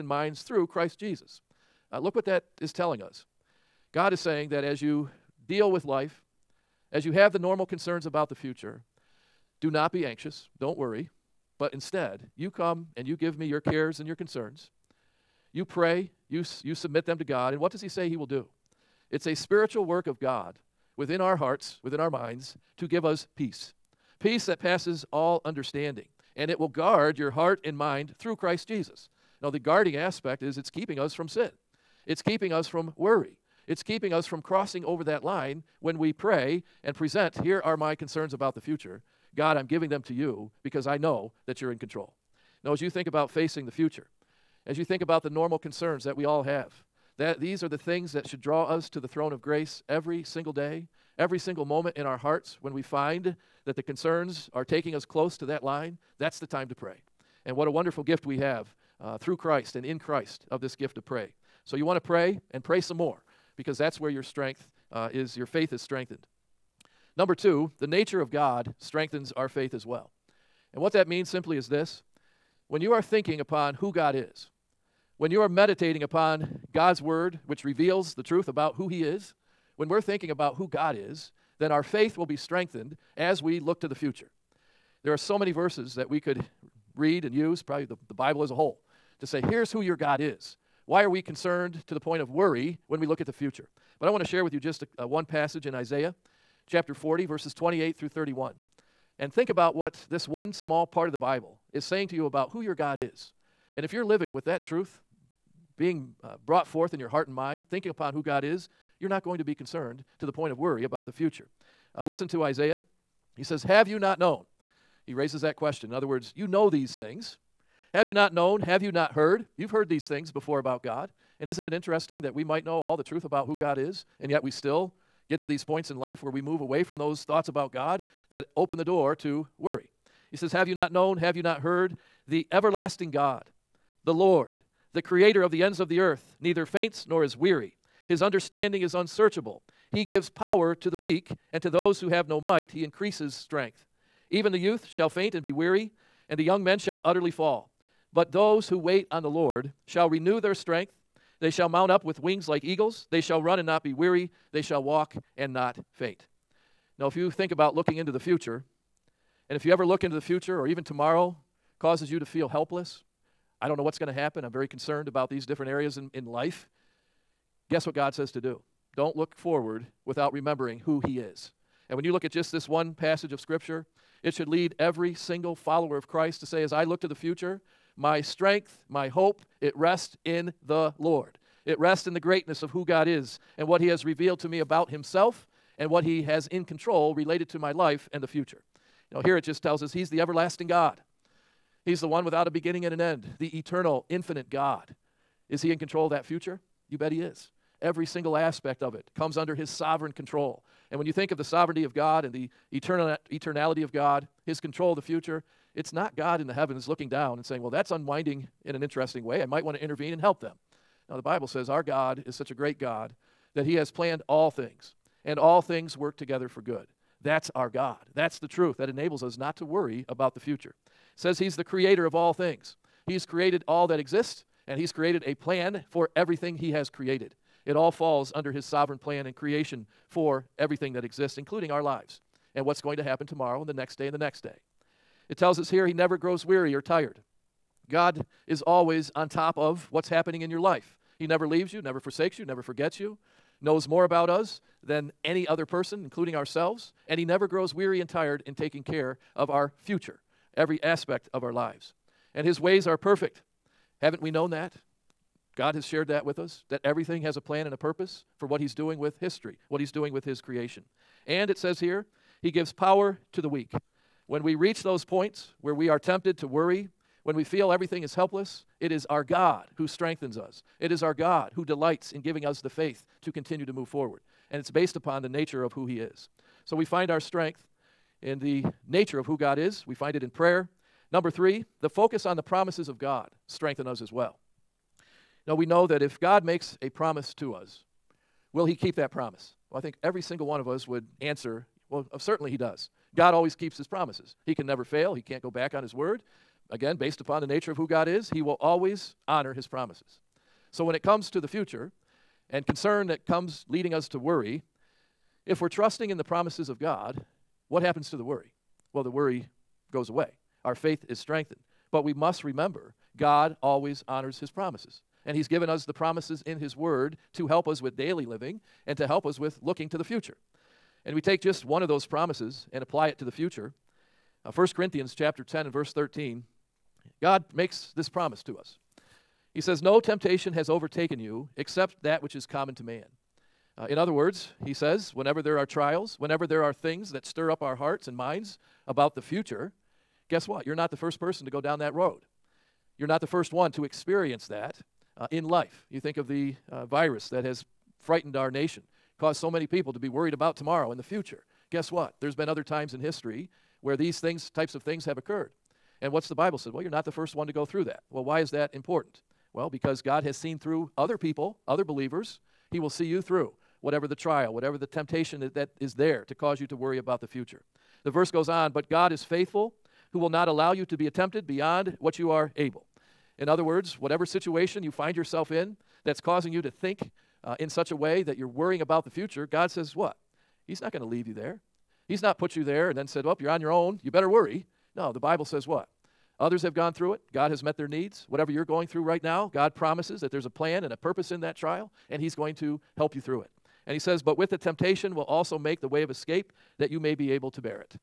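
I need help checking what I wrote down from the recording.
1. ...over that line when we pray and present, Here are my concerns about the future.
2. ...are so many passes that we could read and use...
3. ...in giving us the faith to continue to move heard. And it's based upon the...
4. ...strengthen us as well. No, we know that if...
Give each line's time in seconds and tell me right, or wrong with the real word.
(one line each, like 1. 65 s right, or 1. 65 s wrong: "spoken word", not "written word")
1. 34 s right
2. 85 s wrong: "verses", not "passes"
3. 272 s wrong: "forward", not "heard"
4. 283 s right.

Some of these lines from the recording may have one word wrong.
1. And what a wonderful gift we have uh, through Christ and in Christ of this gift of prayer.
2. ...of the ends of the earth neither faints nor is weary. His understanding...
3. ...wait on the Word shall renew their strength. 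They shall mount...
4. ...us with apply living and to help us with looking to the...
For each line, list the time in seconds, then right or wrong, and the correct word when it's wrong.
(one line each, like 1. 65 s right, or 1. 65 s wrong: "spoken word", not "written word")
1. 57 s right
2. 135 s right
3. 148 s wrong: "Lord", not "Word"
4. 317 s wrong: "daily", not "apply".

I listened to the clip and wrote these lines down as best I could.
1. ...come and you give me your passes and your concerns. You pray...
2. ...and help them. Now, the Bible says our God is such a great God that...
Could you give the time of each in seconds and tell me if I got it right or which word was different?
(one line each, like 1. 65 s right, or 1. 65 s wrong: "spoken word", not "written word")
1. 12 s wrong: "cares", not "passes"
2. 210 s right.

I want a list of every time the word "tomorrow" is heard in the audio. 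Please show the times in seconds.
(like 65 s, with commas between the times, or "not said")
160 s, 233 s, 350 s.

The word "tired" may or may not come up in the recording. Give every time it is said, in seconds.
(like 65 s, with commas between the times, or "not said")
236 s, 248 s.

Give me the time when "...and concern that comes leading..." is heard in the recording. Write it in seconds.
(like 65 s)
302 s.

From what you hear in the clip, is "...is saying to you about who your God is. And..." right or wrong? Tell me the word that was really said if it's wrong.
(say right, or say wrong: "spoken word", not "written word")
right.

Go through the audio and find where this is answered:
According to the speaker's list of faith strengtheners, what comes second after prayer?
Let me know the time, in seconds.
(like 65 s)
67 s.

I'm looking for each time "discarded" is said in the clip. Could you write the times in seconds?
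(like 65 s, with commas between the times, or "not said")
not said.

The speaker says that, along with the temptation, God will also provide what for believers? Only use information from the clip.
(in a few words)
the way of escape.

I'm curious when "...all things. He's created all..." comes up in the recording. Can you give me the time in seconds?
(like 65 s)
222 s.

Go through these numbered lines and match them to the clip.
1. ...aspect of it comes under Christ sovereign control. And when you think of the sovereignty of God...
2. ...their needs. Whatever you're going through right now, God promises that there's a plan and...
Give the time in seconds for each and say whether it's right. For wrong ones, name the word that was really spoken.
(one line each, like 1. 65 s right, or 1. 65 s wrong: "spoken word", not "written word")
1. 198 s wrong: "His", not "Christ"
2. 387 s right.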